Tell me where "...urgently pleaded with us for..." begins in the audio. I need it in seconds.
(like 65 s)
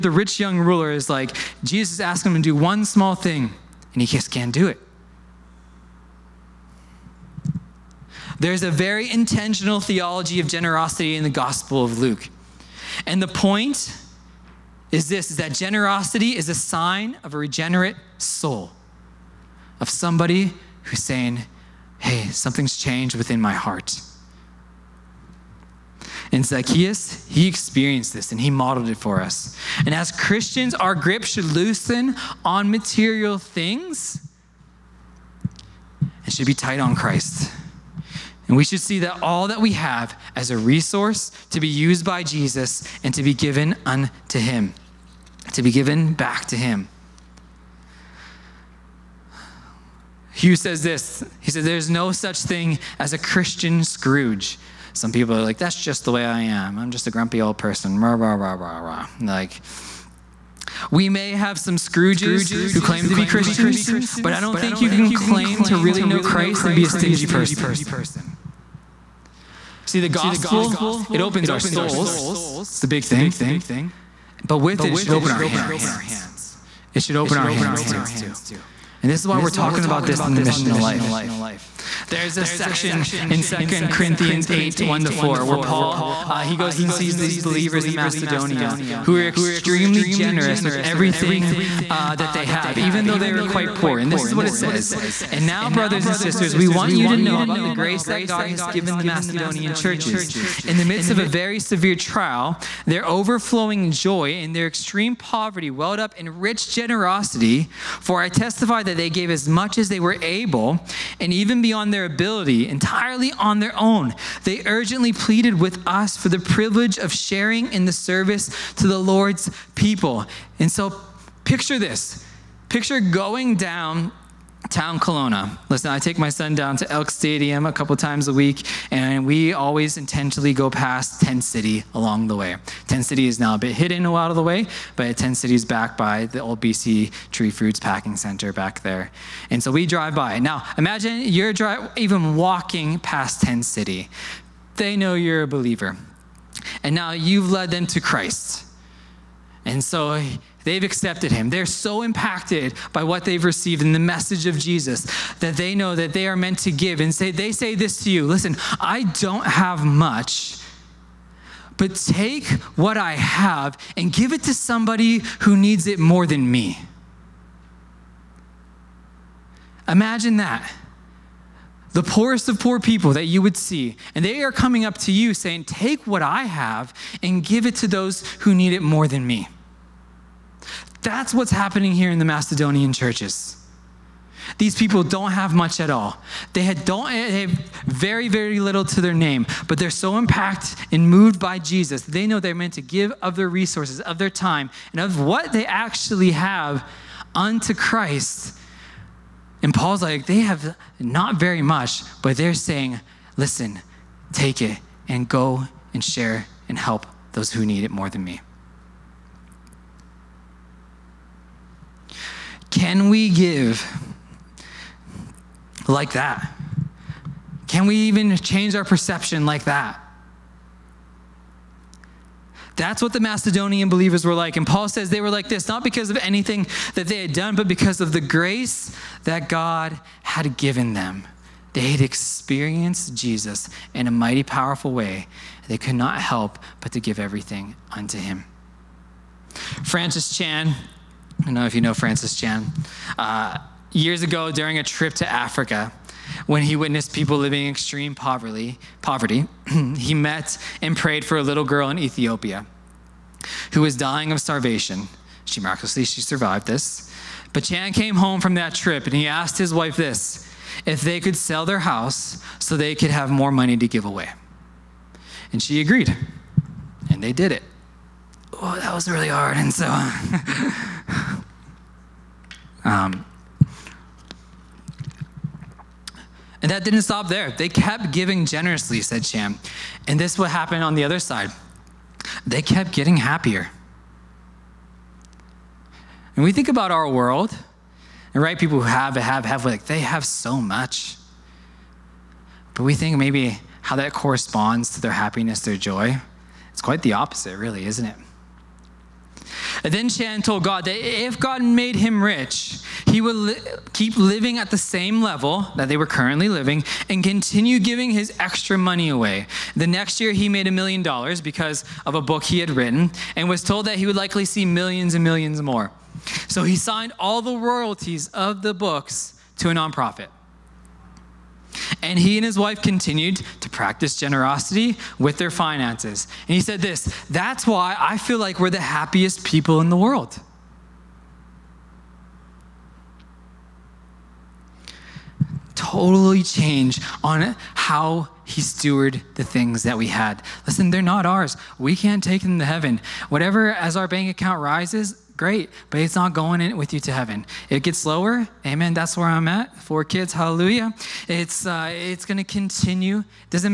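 114 s.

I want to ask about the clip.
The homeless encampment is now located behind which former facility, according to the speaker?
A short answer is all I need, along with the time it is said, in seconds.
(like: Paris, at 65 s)
BC Tree Fruits Packing Center, at 136 s.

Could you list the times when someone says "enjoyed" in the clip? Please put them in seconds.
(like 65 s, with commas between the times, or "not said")
not said.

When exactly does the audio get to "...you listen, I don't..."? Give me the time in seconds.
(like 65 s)
158 s.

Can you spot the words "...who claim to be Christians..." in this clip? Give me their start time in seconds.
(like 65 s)
62 s.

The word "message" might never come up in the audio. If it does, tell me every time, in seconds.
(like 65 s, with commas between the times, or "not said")
153 s.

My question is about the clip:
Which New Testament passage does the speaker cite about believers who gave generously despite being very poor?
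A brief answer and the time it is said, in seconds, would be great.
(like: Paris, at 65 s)
2 Corinthians 8:1-4, at 83 s.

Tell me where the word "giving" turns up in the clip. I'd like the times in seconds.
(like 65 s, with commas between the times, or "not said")
278 s, 307 s.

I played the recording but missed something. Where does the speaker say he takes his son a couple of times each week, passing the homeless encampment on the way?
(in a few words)
Elk Stadium.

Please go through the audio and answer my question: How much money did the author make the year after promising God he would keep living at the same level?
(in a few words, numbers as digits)
$1 million.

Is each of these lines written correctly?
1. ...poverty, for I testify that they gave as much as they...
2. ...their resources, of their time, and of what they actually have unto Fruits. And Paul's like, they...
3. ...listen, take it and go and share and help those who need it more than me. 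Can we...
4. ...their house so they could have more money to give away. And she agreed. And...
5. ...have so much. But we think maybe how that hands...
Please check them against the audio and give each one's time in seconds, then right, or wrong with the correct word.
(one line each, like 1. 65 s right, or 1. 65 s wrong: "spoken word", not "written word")
1. 106 s wrong: "generosity", not "poverty"
2. 193 s wrong: "Christ", not "Fruits"
3. 203 s right
4. 261 s right
5. 289 s wrong: "corresponds", not "hands".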